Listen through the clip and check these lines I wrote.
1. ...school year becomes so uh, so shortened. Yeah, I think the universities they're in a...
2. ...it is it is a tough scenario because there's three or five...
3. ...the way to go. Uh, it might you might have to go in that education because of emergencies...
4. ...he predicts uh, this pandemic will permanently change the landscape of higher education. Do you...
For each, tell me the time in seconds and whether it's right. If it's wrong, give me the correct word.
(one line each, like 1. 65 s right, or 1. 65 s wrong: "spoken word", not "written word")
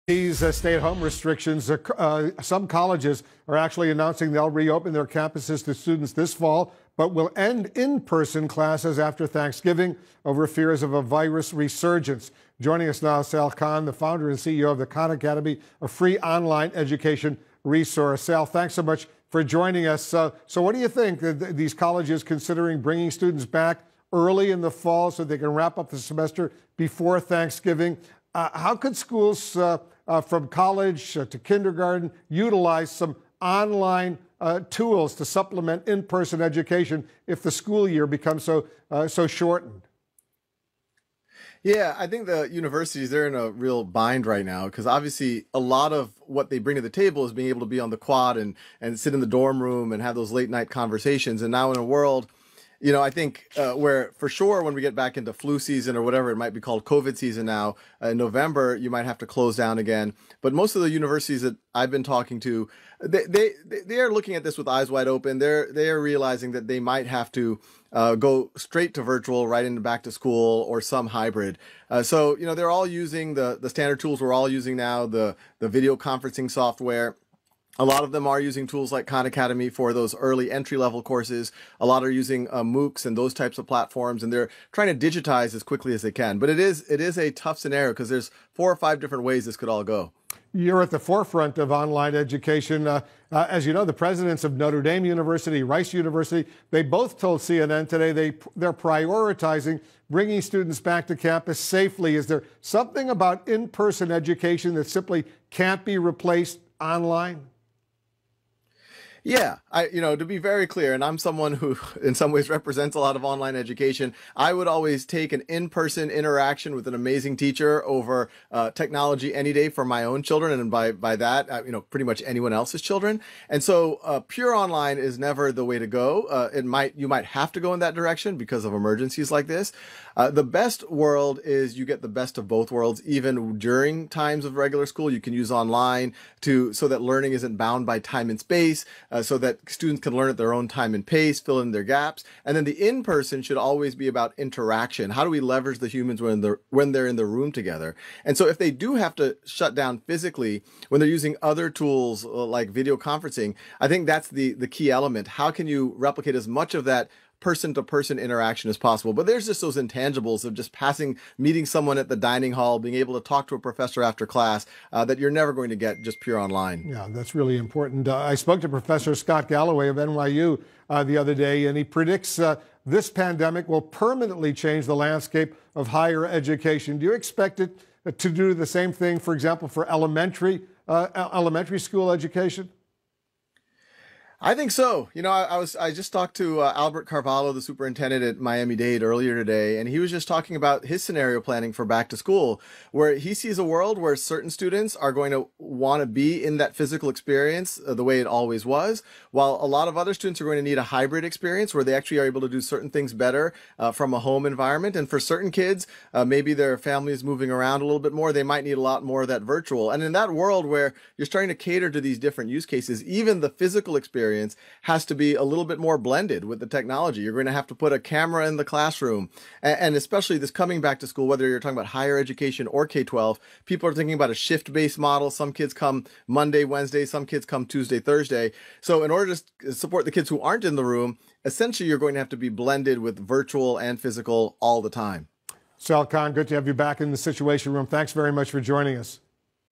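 1. 37 s right
2. 86 s wrong: "four", not "three"
3. 125 s wrong: "direction", not "education"
4. 171 s right.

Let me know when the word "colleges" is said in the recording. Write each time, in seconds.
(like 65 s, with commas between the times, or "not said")
2 s, 21 s, 30 s.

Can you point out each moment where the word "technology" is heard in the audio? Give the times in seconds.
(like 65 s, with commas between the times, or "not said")
118 s, 216 s.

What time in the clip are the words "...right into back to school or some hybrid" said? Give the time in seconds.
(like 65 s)
69 s.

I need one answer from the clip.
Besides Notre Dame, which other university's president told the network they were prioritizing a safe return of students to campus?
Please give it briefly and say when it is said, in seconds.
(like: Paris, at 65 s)
Rice University, at 95 s.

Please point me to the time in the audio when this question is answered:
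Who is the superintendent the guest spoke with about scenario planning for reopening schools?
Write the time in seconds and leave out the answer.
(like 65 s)
186 s.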